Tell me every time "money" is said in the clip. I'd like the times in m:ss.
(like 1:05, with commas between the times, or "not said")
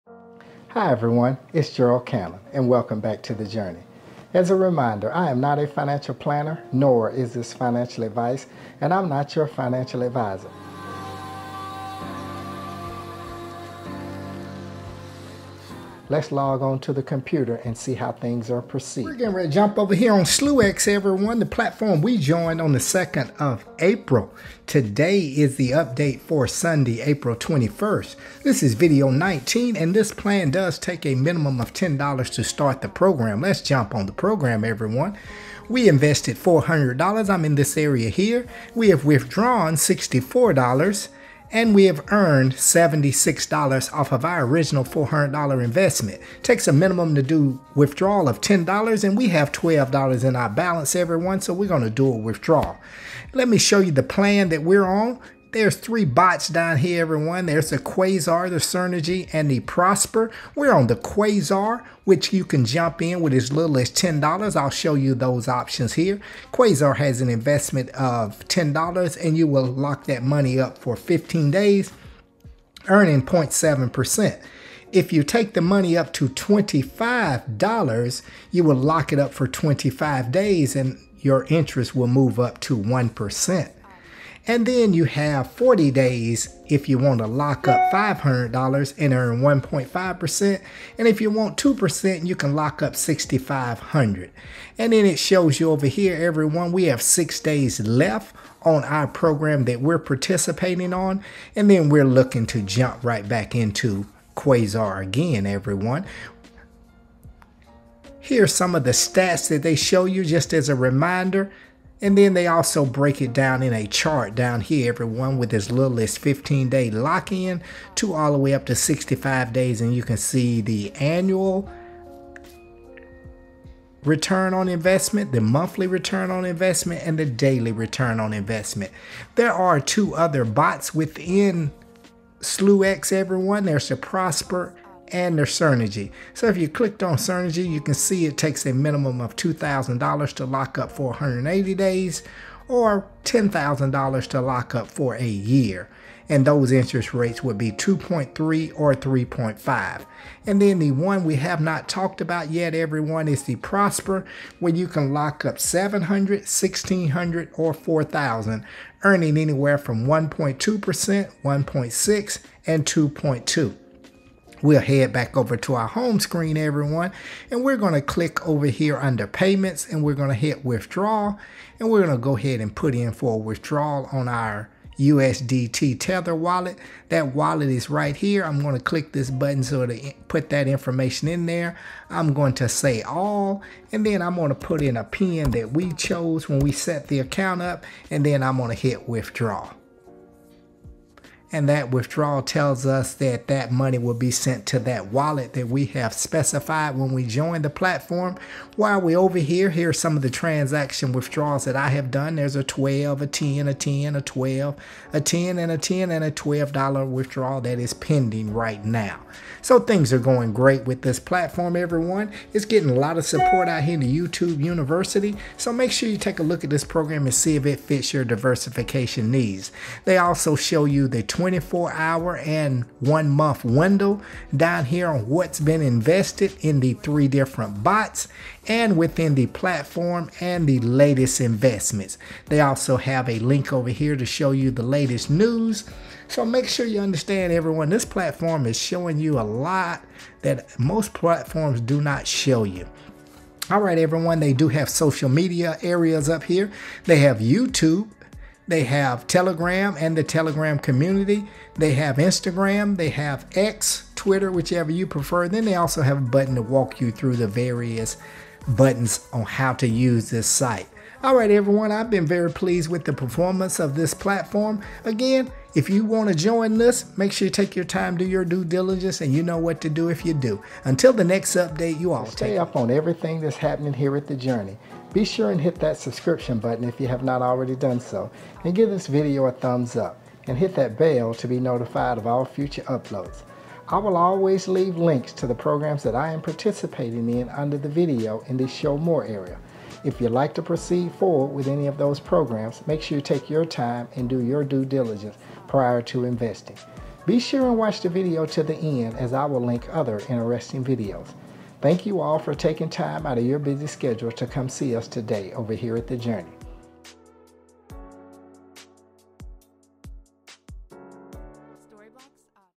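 1:10, 1:15, 3:13.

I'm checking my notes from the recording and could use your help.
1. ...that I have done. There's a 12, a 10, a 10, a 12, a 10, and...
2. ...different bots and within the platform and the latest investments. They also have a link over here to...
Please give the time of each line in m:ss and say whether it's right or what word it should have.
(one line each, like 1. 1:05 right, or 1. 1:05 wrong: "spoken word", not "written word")
1. 3:21 right
2. 3:47 right.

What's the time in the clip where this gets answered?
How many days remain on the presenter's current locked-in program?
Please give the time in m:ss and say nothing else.
1:36.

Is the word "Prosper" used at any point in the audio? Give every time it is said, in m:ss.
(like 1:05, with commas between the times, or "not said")
0:59, 2:13, 2:33.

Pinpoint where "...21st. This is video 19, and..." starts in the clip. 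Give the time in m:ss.
0:27.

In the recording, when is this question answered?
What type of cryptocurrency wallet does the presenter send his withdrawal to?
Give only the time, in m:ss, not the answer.
2:54.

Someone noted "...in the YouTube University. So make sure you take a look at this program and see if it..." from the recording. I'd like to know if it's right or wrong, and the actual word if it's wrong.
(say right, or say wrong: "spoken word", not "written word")
right.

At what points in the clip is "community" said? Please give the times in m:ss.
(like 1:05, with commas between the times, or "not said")
4:10.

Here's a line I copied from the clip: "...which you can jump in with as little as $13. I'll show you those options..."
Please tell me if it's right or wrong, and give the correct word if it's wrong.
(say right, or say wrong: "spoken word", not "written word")
wrong: "10", not "13".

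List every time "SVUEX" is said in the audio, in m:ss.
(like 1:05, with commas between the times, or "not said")
0:20, 2:12.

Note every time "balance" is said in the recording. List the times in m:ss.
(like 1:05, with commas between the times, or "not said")
0:50.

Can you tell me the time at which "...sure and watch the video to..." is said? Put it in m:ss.
4:57.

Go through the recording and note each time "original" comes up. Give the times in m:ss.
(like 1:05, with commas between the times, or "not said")
0:44.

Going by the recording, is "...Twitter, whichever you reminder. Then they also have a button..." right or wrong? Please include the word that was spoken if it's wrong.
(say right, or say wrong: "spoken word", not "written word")
wrong: "prefer", not "reminder".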